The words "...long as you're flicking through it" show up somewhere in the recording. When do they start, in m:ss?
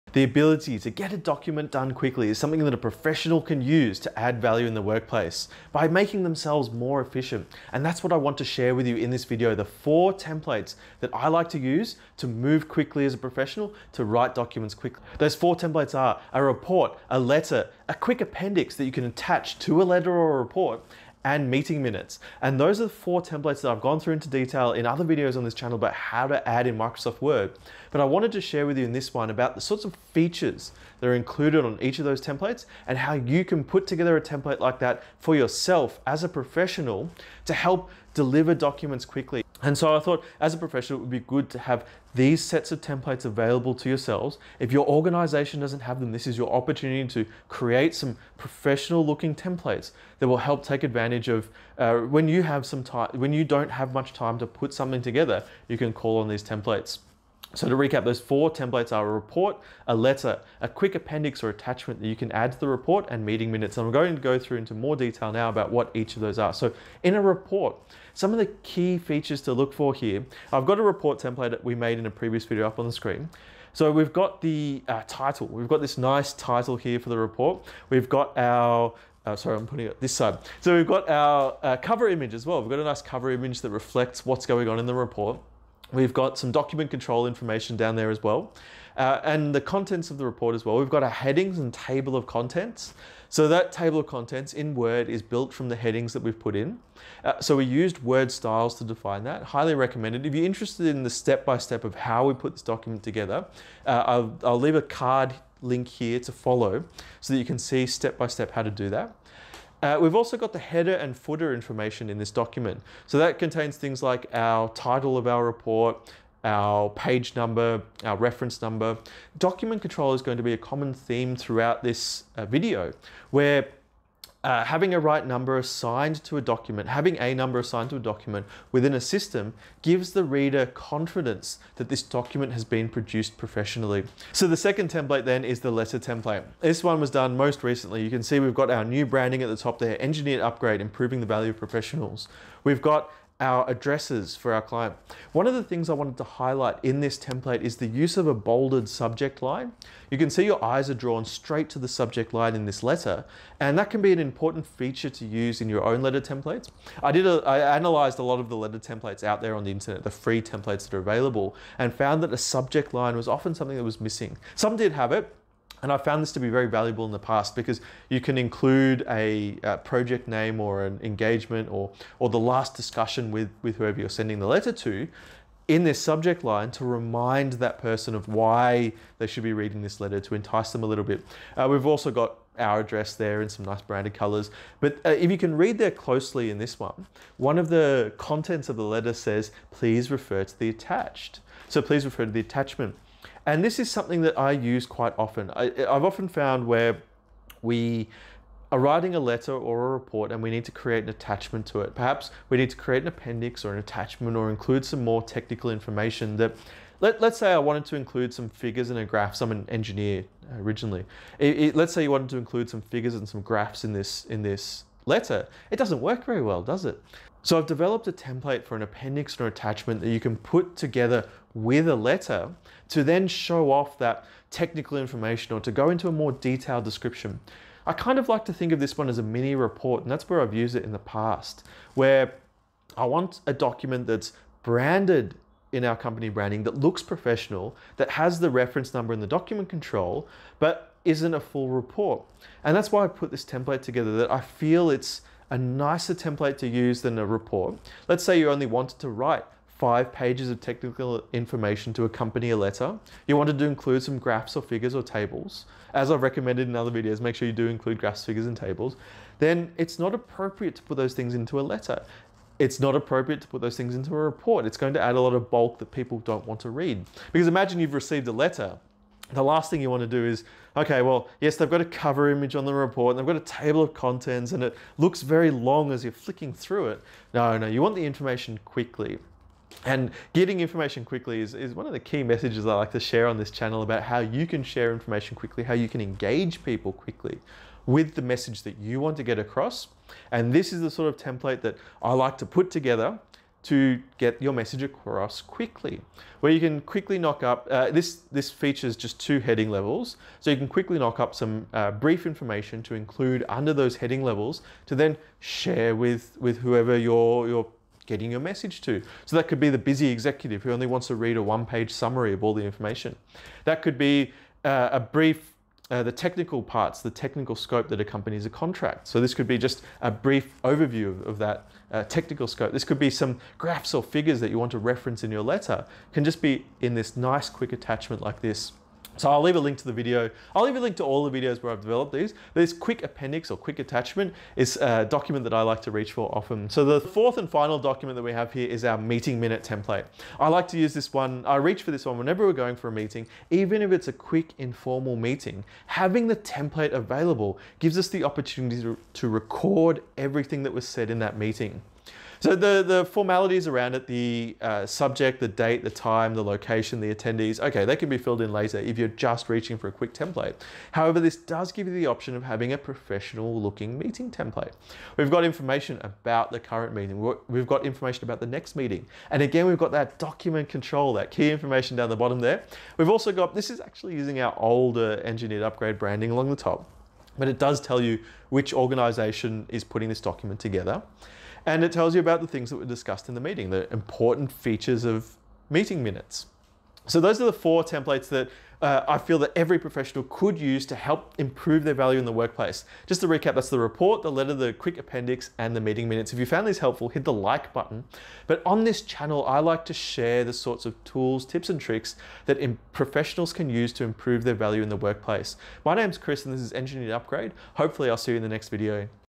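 4:35.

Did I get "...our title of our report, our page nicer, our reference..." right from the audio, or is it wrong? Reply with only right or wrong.
wrong.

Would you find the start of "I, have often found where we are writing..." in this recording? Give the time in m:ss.
3:15.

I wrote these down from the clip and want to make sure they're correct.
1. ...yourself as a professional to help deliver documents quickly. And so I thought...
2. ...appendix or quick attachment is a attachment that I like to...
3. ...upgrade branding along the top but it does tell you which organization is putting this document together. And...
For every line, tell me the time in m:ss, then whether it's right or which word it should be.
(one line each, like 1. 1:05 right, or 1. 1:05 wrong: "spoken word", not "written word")
1. 0:35 right
2. 5:33 wrong: "document", not "attachment"
3. 6:15 right.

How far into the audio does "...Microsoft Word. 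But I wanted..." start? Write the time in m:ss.
0:26.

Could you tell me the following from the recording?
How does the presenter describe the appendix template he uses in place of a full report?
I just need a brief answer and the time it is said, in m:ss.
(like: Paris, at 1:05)
A mini report, at 3:49.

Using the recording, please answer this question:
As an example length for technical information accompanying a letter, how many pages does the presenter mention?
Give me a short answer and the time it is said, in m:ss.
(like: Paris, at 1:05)
5, at 4:09.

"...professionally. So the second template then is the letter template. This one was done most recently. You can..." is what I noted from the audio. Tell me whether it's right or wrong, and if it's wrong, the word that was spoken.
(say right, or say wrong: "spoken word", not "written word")
right.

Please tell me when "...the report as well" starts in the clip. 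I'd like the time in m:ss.
1:30.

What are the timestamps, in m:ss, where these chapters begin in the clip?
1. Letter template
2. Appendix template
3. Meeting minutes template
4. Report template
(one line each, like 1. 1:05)
1. 2:14
2. 3:37
3. 5:37
4. 1:05.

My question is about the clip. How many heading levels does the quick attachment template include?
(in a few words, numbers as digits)
2.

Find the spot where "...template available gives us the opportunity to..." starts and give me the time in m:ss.
5:46.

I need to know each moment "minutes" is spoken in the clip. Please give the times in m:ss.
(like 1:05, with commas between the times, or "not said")
0:21, 1:03, 5:39, 6:26, 6:36.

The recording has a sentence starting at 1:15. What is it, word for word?
We've got this nice title here for the report.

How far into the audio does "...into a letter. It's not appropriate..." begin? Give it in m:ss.
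4:21.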